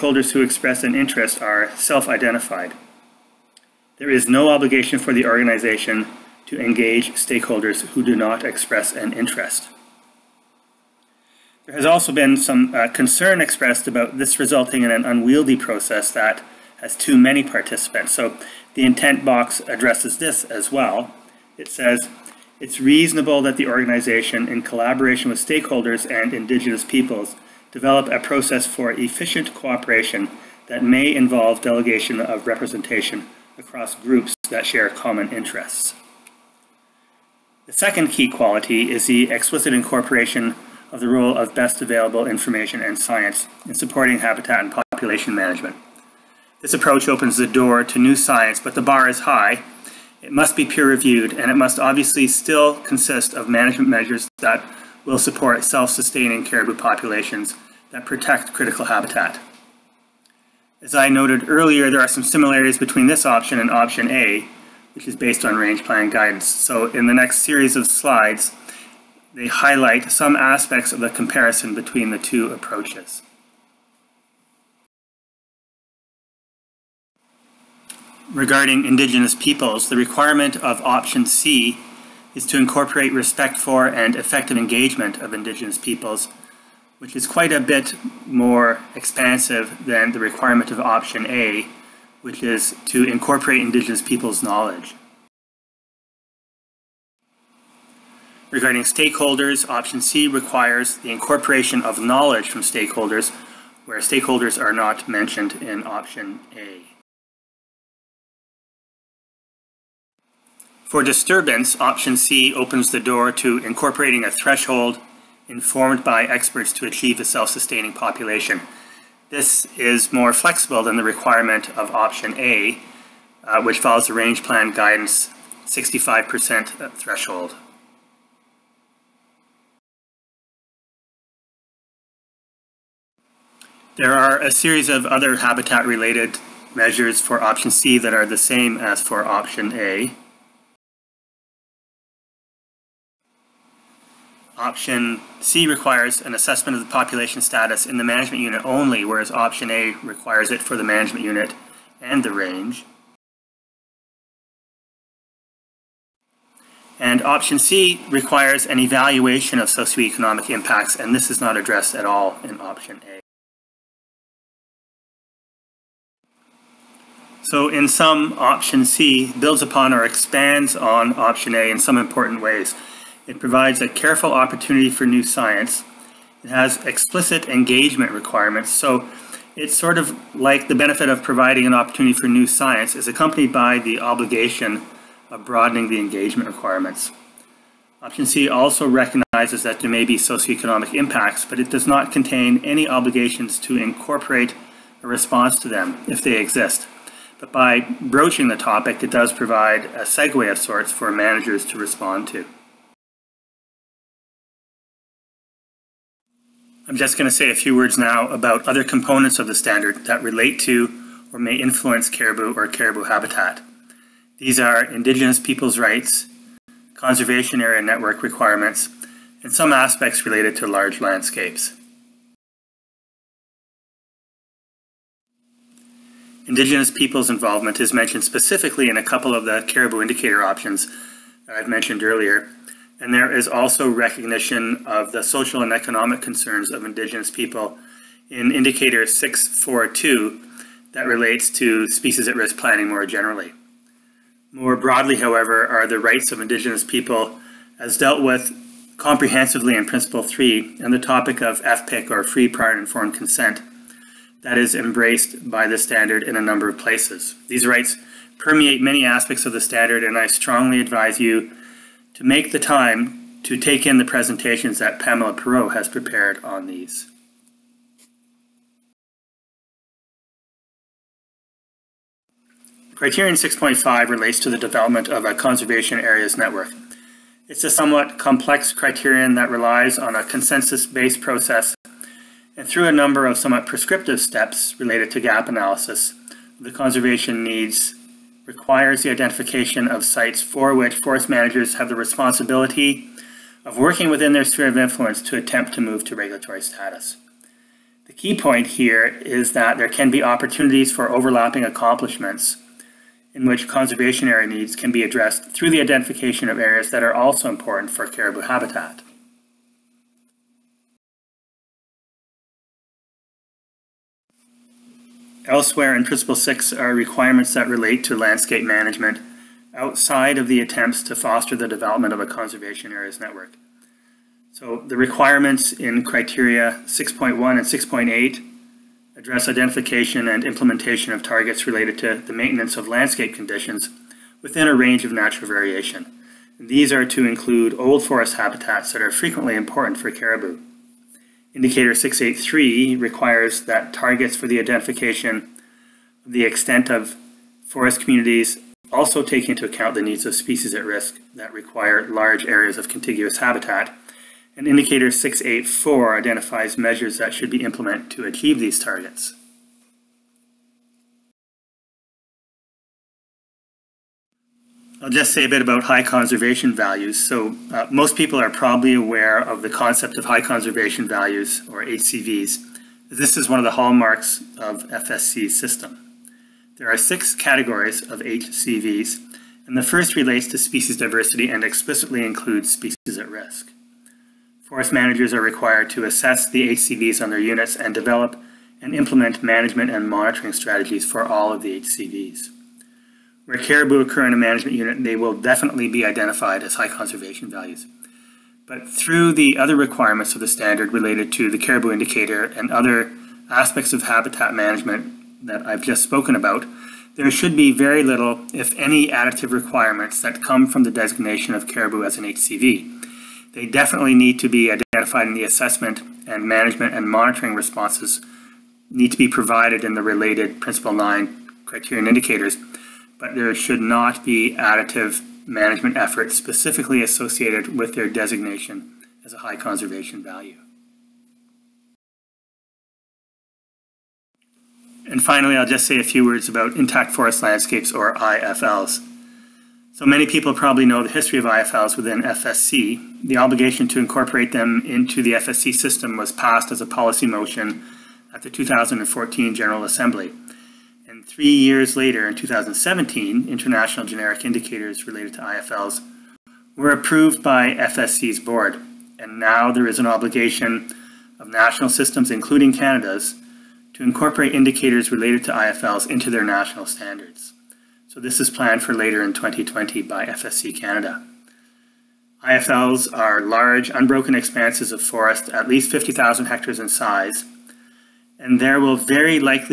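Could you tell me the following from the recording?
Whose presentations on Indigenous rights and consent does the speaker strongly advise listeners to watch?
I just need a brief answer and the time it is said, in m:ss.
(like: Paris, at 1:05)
Pamela Perreault, at 4:24.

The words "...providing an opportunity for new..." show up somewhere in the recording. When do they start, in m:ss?
3:01.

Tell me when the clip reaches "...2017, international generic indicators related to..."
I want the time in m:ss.
7:32.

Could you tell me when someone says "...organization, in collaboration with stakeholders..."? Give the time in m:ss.
0:23.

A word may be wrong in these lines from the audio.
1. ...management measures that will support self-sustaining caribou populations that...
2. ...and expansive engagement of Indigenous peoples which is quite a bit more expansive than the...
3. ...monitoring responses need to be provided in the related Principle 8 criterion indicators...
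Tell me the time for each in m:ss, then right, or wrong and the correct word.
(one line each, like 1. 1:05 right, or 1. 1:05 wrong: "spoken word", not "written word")
1. 0:53 right
2. 1:23 wrong: "effective", not "expansive"
3. 6:57 wrong: "9", not "8".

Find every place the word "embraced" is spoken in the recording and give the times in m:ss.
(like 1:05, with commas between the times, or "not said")
4:14.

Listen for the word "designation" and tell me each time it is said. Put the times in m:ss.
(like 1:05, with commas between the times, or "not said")
6:50, 7:08.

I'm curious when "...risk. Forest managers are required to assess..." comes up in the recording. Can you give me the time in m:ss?
6:23.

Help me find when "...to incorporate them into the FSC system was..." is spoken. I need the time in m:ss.
7:23.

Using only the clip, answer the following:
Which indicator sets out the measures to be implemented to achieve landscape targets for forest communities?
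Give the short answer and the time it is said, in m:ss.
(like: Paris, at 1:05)
Indicator 684, at 5:54.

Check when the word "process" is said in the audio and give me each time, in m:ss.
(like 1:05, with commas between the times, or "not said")
0:15, 0:28, 4:41.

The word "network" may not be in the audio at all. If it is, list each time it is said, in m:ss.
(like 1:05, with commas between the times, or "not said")
3:37, 4:36, 5:23.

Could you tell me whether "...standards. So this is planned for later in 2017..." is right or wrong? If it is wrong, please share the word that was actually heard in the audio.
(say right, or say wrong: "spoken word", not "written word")
wrong: "2020", not "2017".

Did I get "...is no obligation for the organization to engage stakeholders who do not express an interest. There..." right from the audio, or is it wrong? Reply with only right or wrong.
right.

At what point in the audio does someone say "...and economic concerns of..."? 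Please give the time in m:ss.
3:55.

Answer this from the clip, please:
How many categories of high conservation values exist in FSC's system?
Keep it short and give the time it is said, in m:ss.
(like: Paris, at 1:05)
6, at 6:16.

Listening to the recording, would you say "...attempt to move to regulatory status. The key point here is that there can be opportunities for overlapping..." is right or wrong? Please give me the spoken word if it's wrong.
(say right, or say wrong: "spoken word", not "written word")
right.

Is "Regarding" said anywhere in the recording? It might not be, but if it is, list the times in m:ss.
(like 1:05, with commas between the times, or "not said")
1:18, 1:38.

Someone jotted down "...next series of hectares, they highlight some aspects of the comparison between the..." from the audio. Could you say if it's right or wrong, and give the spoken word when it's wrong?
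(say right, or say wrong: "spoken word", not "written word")
wrong: "slides", not "hectares".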